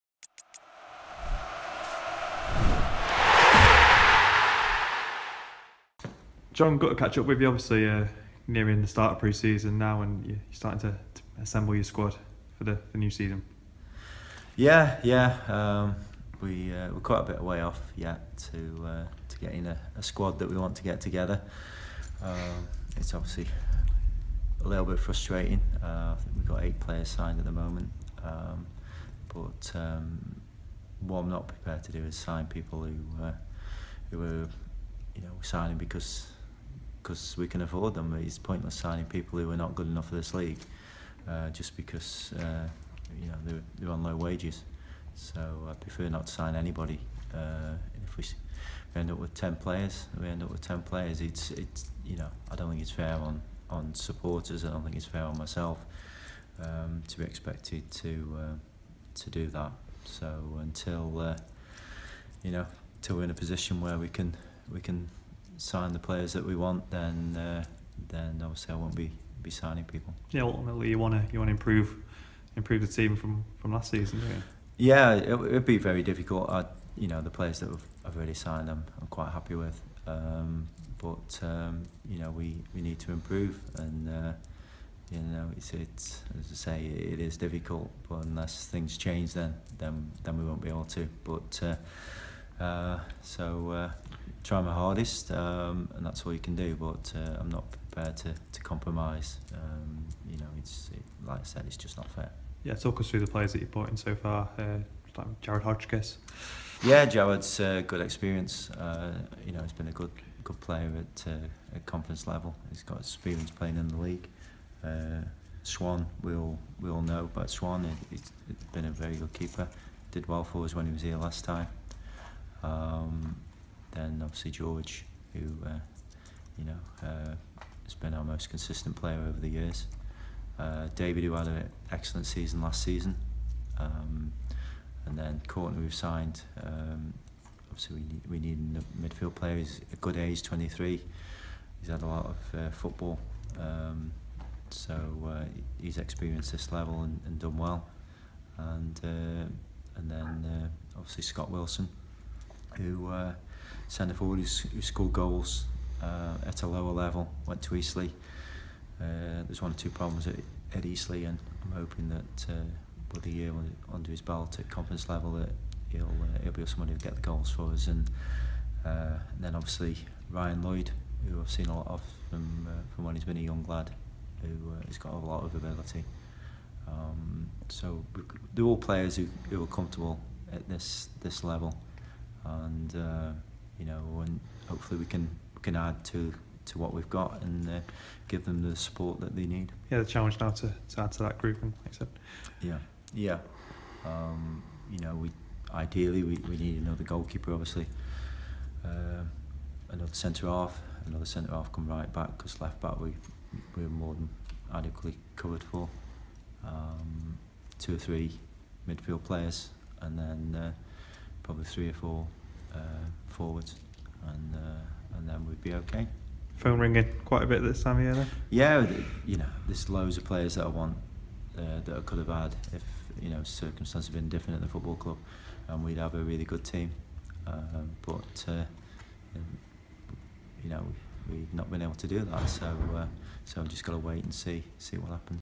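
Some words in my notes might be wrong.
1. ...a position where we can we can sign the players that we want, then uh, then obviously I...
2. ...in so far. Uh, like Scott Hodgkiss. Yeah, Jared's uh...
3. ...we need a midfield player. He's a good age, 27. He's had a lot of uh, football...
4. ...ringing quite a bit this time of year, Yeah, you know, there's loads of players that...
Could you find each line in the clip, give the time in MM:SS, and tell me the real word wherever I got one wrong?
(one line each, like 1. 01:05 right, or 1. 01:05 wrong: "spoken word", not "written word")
1. 01:03 right
2. 01:43 wrong: "Jared", not "Scott"
3. 02:18 wrong: "23", not "27"
4. 03:36 right.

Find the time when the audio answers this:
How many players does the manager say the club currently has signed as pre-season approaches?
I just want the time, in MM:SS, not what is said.
00:26.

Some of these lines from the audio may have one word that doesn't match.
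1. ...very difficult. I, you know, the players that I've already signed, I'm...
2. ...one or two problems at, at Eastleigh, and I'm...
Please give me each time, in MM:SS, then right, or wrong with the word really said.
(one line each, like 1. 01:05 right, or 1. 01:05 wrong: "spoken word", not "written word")
1. 01:15 right
2. 02:39 right.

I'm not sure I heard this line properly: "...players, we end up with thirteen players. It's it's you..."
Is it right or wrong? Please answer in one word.
wrong.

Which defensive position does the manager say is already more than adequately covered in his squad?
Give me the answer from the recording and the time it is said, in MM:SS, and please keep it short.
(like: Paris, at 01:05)
Left back, at 03:22.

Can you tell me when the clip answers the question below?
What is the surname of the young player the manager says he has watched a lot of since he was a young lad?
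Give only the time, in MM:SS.
02:50.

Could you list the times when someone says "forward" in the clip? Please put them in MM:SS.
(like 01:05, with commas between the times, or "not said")
02:34, 03:33.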